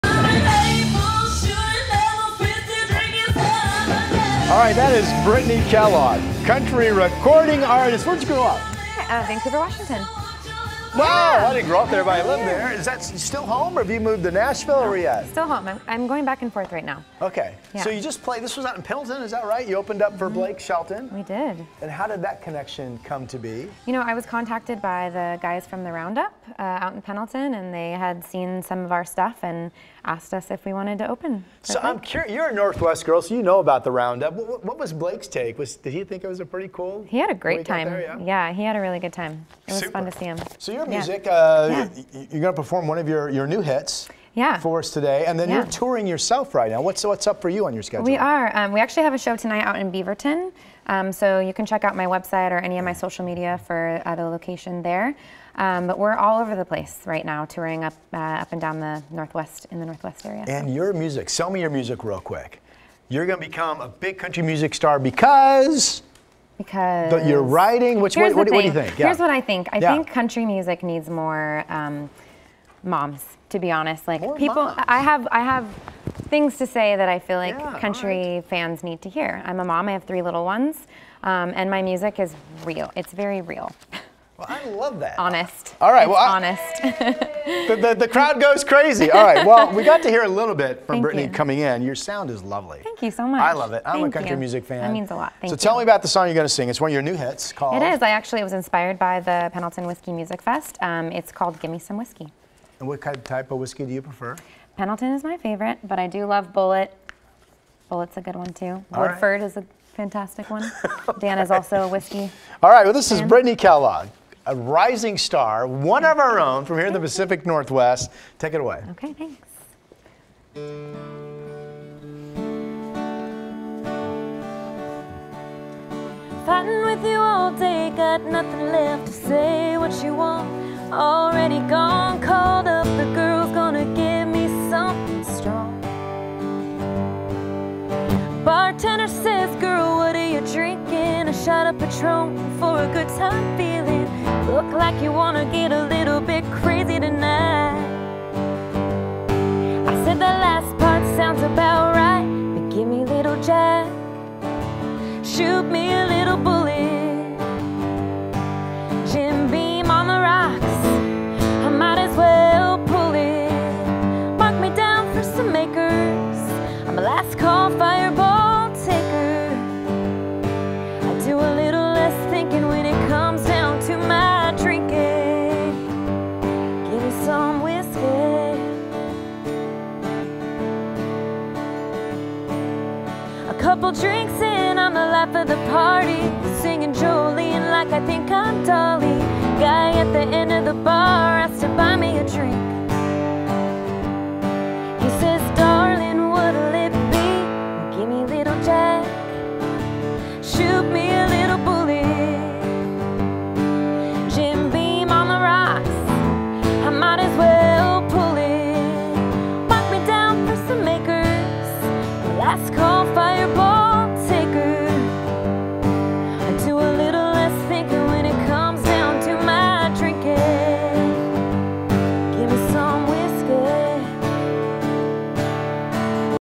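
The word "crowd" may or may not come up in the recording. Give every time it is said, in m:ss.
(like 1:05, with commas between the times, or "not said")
1:28.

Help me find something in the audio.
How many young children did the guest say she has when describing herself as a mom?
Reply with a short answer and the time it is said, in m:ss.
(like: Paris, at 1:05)
3, at 1:20.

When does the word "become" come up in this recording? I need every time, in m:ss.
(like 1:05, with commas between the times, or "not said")
1:03.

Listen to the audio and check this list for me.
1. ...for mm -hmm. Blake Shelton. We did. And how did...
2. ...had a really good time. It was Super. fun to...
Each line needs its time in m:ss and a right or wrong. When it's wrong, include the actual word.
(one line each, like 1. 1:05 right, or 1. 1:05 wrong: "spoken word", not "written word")
1. 0:20 right
2. 0:38 right.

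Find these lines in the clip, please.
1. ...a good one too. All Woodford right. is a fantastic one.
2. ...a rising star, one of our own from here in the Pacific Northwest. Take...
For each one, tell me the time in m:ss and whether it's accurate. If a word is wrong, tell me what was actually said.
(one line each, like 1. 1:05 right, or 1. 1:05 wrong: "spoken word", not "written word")
1. 1:48 right
2. 1:54 right.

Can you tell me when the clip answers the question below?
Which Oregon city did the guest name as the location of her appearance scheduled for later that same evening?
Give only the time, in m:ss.
0:49.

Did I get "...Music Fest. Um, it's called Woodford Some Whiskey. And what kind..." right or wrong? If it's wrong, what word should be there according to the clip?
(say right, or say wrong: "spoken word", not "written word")
wrong: "Gimme", not "Woodford".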